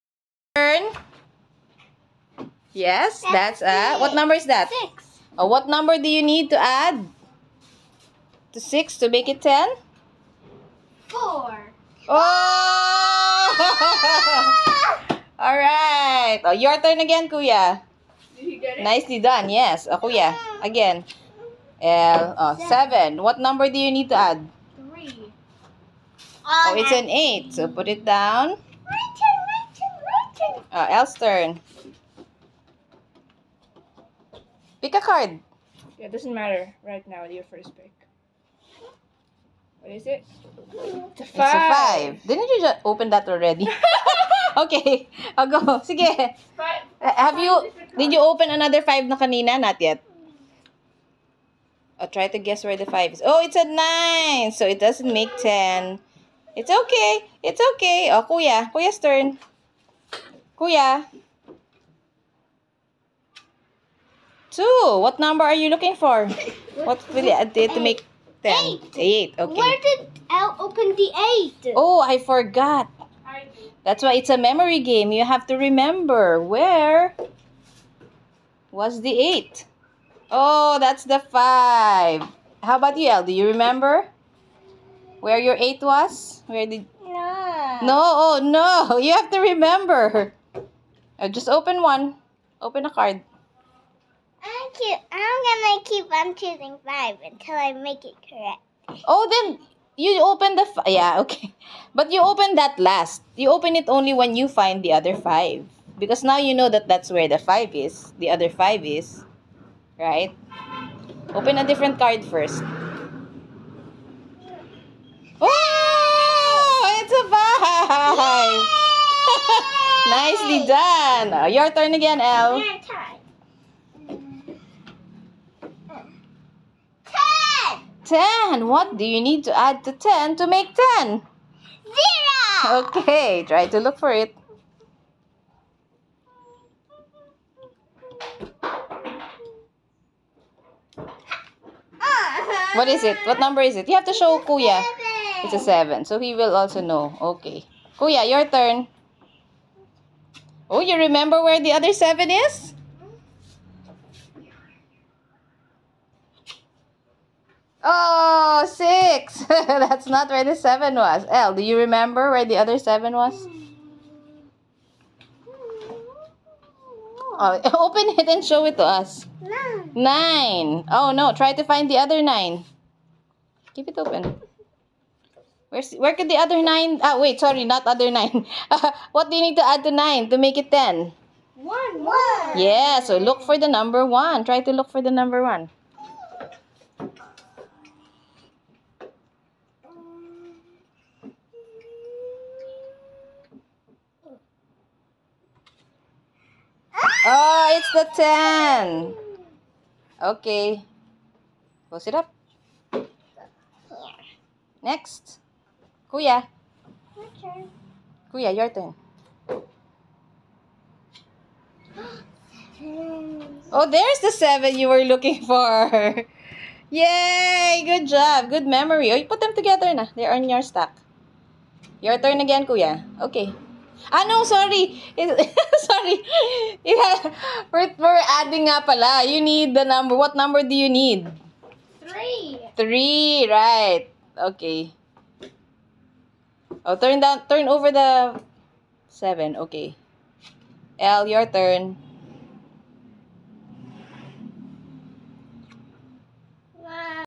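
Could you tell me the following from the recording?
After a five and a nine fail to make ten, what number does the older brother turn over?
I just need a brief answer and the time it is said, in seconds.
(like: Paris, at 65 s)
2, at 64 s.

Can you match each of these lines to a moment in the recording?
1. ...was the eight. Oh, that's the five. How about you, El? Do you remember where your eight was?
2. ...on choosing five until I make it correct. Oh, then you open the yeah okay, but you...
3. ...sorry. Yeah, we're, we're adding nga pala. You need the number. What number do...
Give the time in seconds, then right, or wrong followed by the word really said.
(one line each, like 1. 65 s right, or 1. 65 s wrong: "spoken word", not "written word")
1. 78 s right
2. 96 s right
3. 225 s right.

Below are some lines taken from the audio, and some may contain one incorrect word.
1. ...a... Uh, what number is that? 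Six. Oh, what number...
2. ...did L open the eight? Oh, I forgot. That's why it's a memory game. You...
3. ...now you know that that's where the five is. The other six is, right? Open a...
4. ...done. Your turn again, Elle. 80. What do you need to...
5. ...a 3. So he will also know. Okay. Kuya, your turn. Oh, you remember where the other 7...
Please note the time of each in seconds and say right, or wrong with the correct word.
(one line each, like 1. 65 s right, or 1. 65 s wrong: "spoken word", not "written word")
1. 3 s right
2. 69 s right
3. 106 s wrong: "five", not "six"
4. 120 s wrong: "10", not "80"
5. 145 s wrong: "7", not "3".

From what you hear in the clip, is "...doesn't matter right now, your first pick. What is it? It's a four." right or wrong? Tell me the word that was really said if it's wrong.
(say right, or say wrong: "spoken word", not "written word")
wrong: "five", not "four".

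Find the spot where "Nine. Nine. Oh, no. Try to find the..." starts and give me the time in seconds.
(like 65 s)
169 s.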